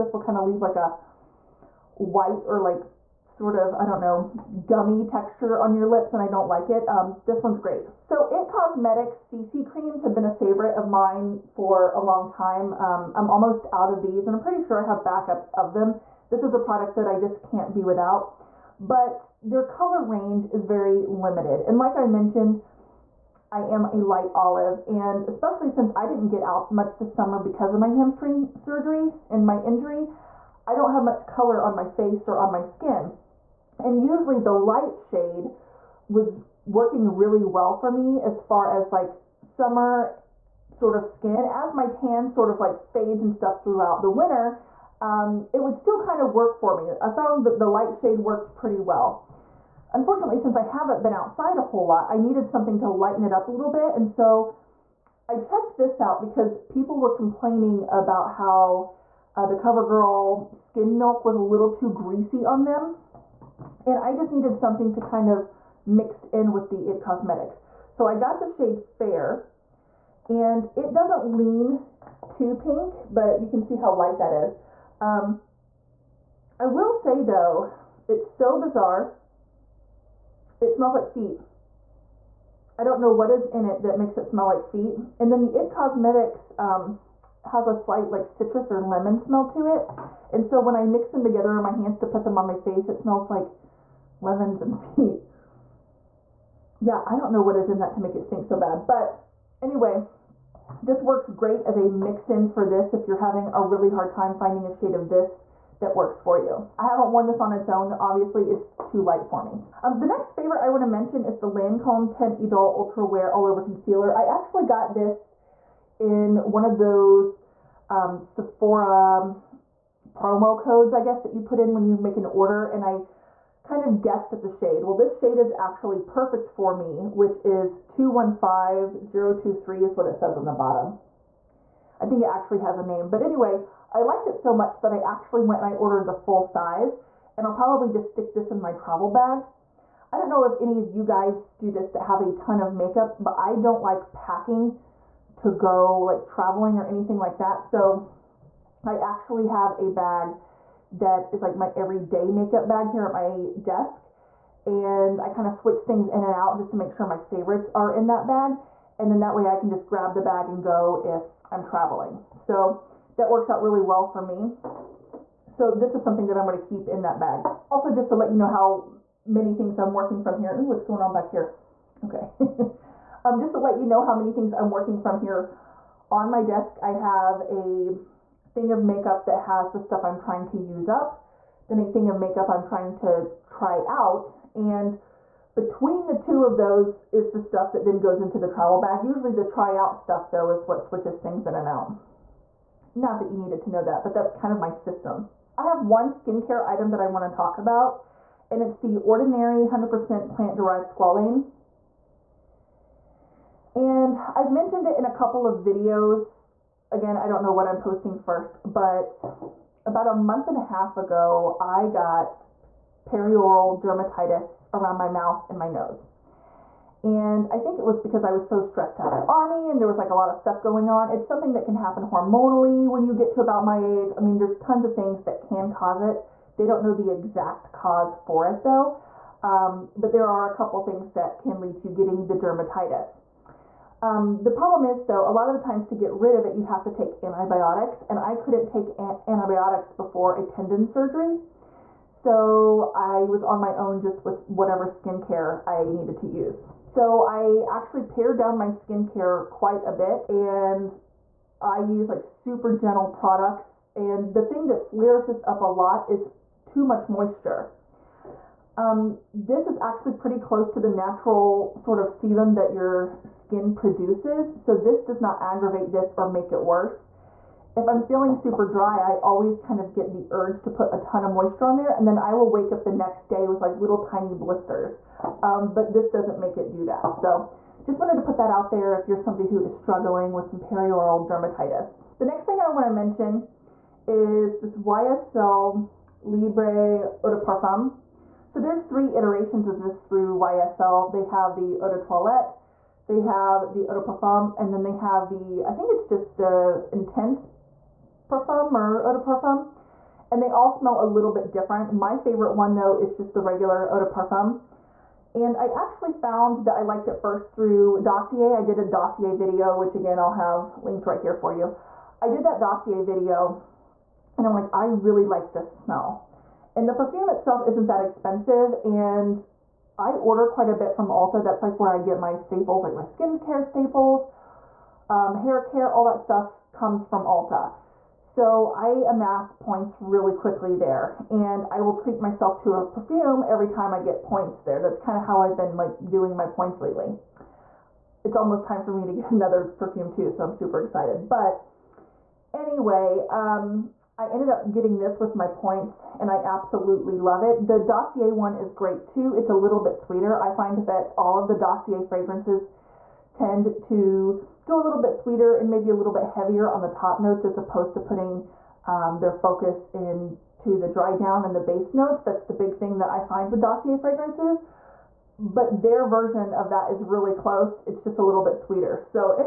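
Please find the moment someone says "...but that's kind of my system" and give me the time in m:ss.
3:14.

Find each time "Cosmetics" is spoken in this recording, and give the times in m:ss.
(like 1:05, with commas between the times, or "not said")
0:08, 1:07, 1:25.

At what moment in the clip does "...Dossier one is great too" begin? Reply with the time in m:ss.
5:47.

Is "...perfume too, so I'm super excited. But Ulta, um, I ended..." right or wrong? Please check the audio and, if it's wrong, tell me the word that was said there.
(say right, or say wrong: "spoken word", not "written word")
wrong: "Anyway", not "Ulta".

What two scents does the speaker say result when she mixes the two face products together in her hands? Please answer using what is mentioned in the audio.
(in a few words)
Lemons and feet.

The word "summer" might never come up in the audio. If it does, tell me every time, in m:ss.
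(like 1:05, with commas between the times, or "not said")
0:27, 0:39.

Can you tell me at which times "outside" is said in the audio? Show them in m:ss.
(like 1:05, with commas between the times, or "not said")
0:51.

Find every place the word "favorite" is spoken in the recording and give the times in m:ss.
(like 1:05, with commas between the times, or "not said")
0:10, 1:50, 2:37, 5:02.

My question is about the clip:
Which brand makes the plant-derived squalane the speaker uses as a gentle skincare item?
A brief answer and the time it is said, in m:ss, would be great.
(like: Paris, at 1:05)
The Ordinary, at 3:19.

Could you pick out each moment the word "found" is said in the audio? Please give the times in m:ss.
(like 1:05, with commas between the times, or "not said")
0:47, 5:06.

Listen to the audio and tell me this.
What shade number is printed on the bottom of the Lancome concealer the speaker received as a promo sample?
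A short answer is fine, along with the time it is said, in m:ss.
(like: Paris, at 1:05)
215023, at 2:07.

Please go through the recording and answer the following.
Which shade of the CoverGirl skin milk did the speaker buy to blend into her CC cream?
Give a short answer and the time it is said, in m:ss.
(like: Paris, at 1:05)
Fair, at 1:08.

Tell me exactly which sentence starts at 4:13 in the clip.
And the thing that flares this up a lot is too much moisture.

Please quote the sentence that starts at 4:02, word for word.
So I was on my own just with whatever skincare I needed to use.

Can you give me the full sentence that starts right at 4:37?
So just wanted to put that out there if you're somebody who is struggling with some perioral dermatitis.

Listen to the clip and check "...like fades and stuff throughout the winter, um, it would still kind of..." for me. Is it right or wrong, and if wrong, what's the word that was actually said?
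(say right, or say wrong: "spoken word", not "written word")
right.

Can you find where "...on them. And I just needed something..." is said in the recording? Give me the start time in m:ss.
1:02.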